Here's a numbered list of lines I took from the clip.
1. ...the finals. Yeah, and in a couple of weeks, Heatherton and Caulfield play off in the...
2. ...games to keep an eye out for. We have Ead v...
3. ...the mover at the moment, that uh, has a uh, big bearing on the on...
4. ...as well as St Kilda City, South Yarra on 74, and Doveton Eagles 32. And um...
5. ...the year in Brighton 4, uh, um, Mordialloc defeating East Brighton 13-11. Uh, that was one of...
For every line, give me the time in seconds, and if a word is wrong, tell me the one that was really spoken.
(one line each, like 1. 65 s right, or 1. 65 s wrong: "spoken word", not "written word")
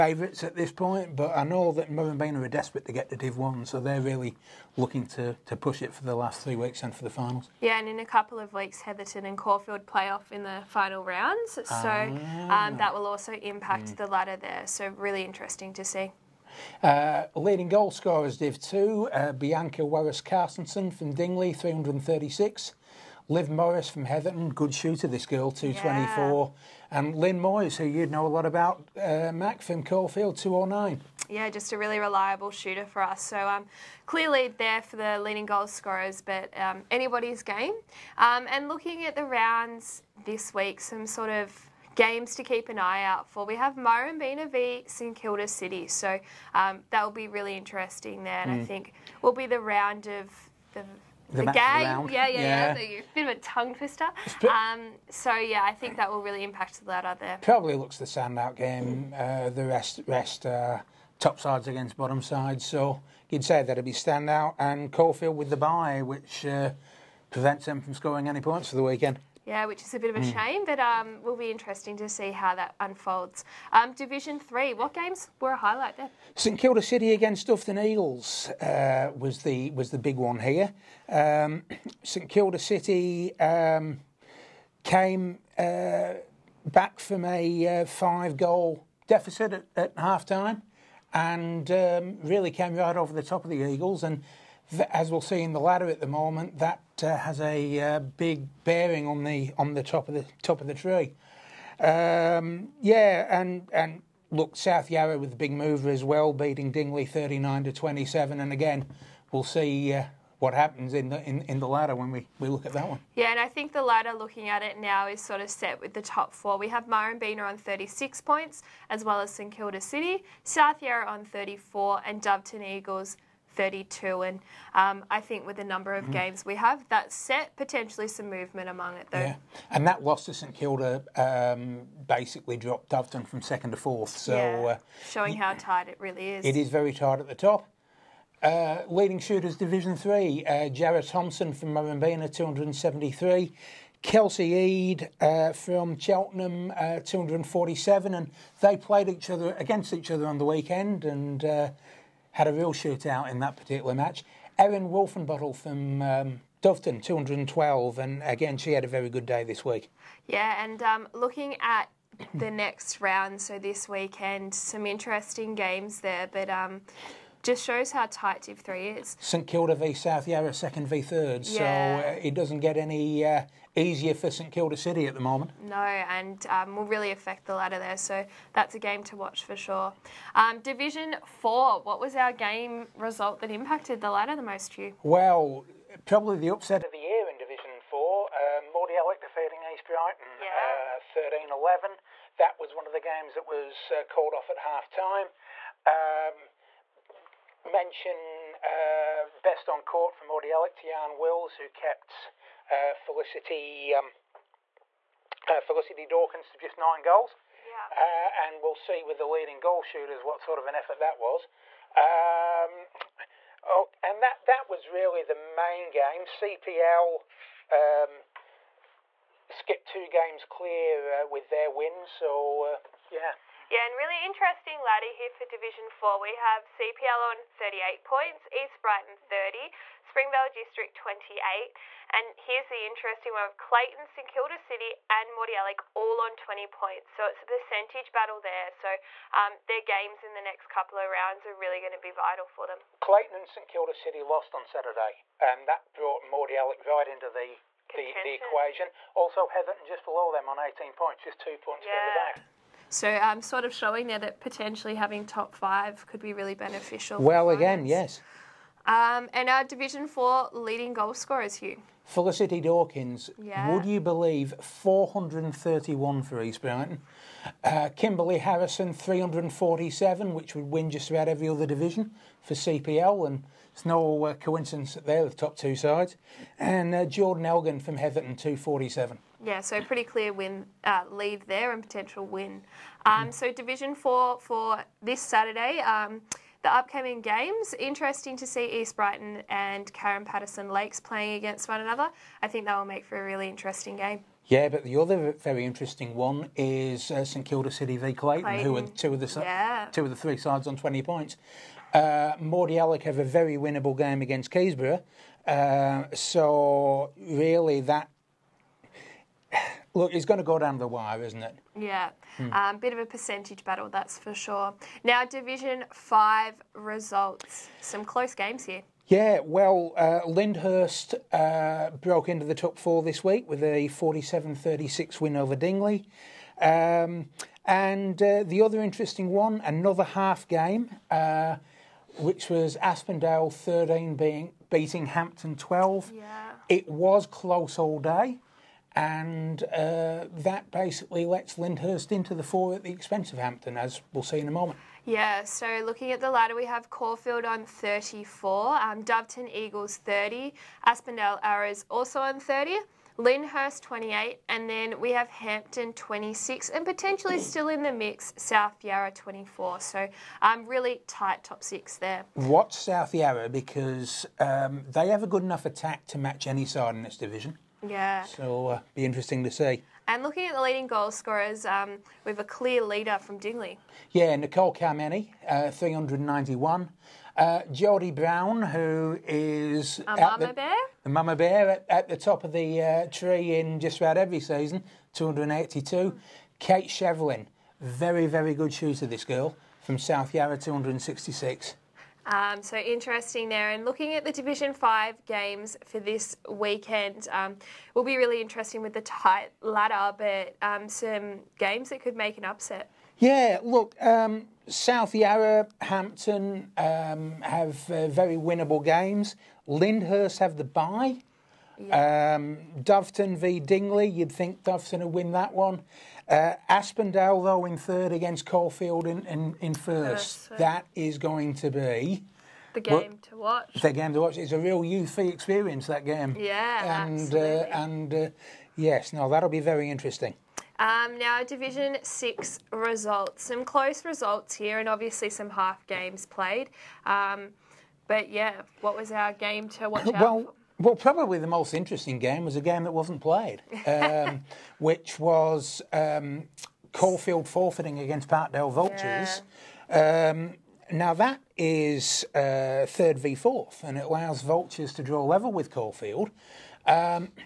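1. 7 s right
2. 41 s wrong: "Murrumbeena", not "Ead"
3. 95 s wrong: "ladder", not "mover"
4. 118 s wrong: "34", not "74"
5. 186 s wrong: "Division", not "Brighton".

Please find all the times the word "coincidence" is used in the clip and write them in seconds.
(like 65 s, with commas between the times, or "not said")
274 s.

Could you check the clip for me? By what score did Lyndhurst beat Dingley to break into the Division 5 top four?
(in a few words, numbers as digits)
47-36.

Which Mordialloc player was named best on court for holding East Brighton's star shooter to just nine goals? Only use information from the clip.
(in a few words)
Jan Wills.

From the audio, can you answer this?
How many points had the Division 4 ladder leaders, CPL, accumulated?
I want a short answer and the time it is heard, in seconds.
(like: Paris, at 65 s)
38, at 227 s.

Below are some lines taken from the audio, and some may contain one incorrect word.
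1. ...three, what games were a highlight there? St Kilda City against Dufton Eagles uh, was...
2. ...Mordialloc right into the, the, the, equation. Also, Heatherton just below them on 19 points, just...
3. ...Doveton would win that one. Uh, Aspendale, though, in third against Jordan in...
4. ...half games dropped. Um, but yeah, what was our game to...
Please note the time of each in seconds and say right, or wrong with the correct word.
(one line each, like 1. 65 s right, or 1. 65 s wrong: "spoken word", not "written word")
1. 74 s right
2. 246 s wrong: "18", not "19"
3. 414 s wrong: "Caulfield", not "Jordan"
4. 435 s wrong: "played", not "dropped".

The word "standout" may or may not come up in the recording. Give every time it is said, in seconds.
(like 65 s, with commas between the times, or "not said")
58 s, 63 s.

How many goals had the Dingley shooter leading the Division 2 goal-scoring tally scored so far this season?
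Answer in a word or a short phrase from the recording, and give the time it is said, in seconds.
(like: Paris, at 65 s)
336, at 21 s.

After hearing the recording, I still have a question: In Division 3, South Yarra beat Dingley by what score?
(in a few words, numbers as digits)
39 to 27.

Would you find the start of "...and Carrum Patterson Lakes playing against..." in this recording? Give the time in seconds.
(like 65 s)
289 s.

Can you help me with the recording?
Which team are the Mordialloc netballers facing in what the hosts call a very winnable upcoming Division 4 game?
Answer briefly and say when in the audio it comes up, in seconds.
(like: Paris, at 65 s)
Keysborough, at 304 s.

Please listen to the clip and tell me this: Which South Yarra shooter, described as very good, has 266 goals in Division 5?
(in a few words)
Kate Shevlin.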